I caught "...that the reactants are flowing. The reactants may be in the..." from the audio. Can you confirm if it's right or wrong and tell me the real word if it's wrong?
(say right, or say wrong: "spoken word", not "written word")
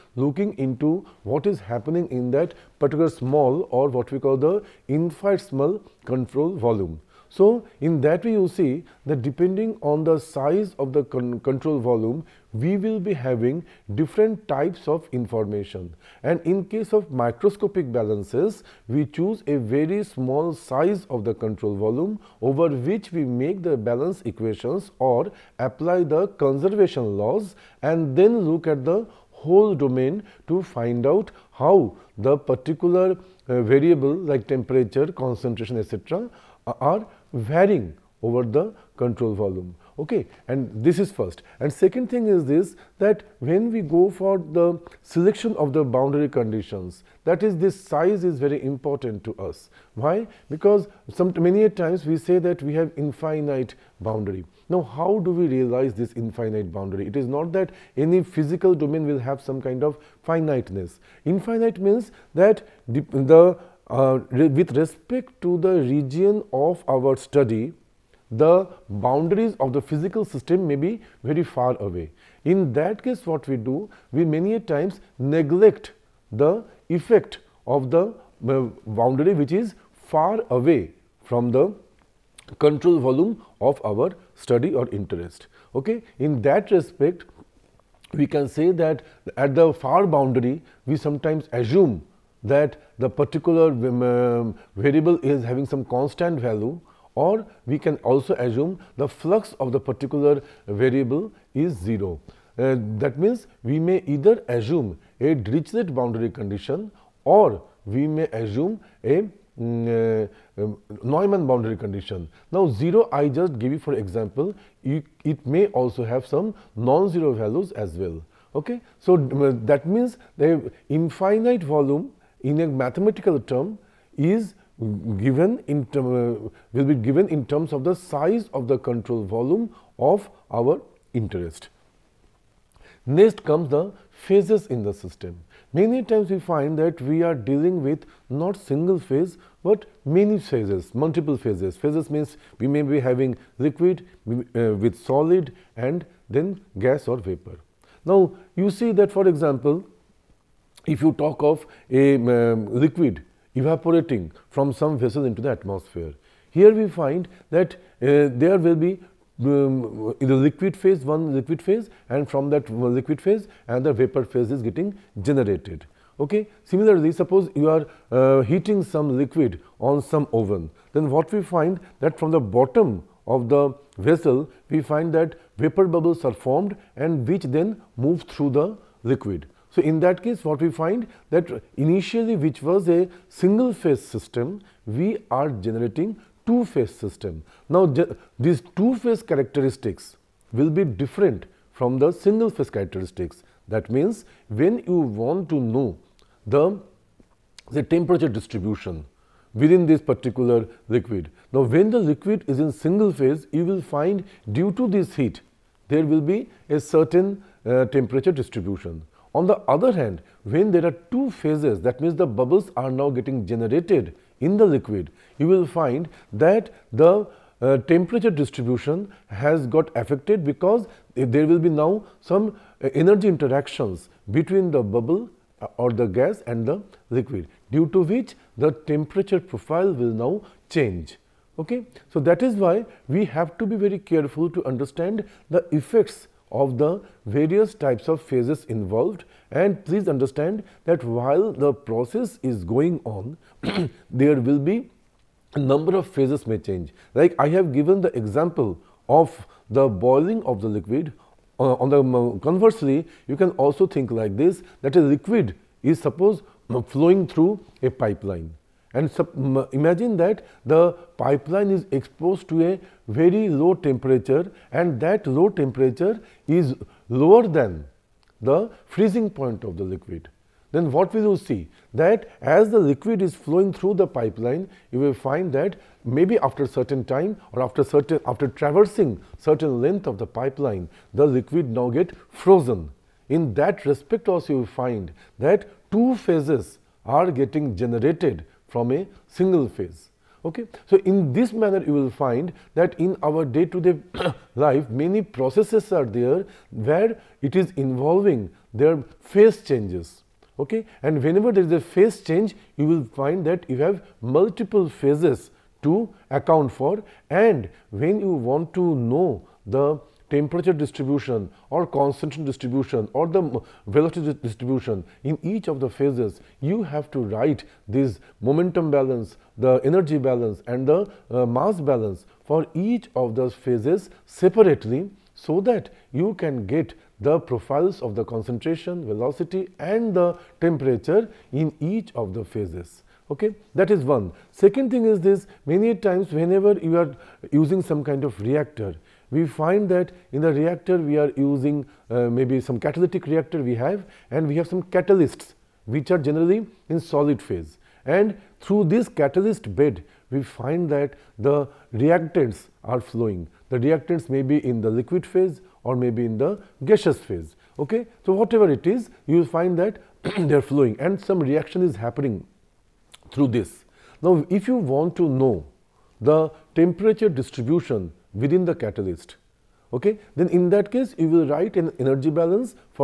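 right.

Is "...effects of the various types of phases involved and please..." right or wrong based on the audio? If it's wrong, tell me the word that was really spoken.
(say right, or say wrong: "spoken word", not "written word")
right.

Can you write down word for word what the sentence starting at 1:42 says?
Uh, that means, we may either assume a Dirichlet boundary condition or we may assume a mm, uh, um, Neumann boundary condition.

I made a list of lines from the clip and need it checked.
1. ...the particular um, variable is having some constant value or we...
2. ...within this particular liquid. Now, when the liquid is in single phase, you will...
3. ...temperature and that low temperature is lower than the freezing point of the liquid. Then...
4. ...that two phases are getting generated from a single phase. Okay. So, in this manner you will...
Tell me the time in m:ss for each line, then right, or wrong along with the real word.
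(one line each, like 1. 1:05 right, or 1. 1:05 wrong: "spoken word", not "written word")
1. 1:32 right
2. 3:19 right
3. 4:23 right
4. 4:45 right.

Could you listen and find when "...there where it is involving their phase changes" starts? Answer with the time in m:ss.
4:56.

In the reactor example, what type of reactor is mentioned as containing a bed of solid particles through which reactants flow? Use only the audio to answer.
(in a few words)
Catalytic reactor.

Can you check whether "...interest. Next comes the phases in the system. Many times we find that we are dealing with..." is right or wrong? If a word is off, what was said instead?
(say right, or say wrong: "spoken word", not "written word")
right.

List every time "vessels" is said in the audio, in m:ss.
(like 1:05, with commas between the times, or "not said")
2:34, 2:53.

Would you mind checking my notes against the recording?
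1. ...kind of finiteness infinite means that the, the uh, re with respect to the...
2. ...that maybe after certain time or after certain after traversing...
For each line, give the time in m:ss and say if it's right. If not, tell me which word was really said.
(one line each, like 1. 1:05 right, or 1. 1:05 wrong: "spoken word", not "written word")
1. 0:59 right
2. 4:35 right.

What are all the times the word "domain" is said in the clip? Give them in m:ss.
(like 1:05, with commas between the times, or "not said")
0:29, 0:58.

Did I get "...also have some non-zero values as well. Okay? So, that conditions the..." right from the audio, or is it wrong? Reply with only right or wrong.
wrong.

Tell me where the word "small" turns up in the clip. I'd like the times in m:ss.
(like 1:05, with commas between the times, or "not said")
0:03, 0:20.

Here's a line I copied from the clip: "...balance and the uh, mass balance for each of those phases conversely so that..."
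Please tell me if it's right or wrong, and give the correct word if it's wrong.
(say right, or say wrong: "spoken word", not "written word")
wrong: "separately", not "conversely".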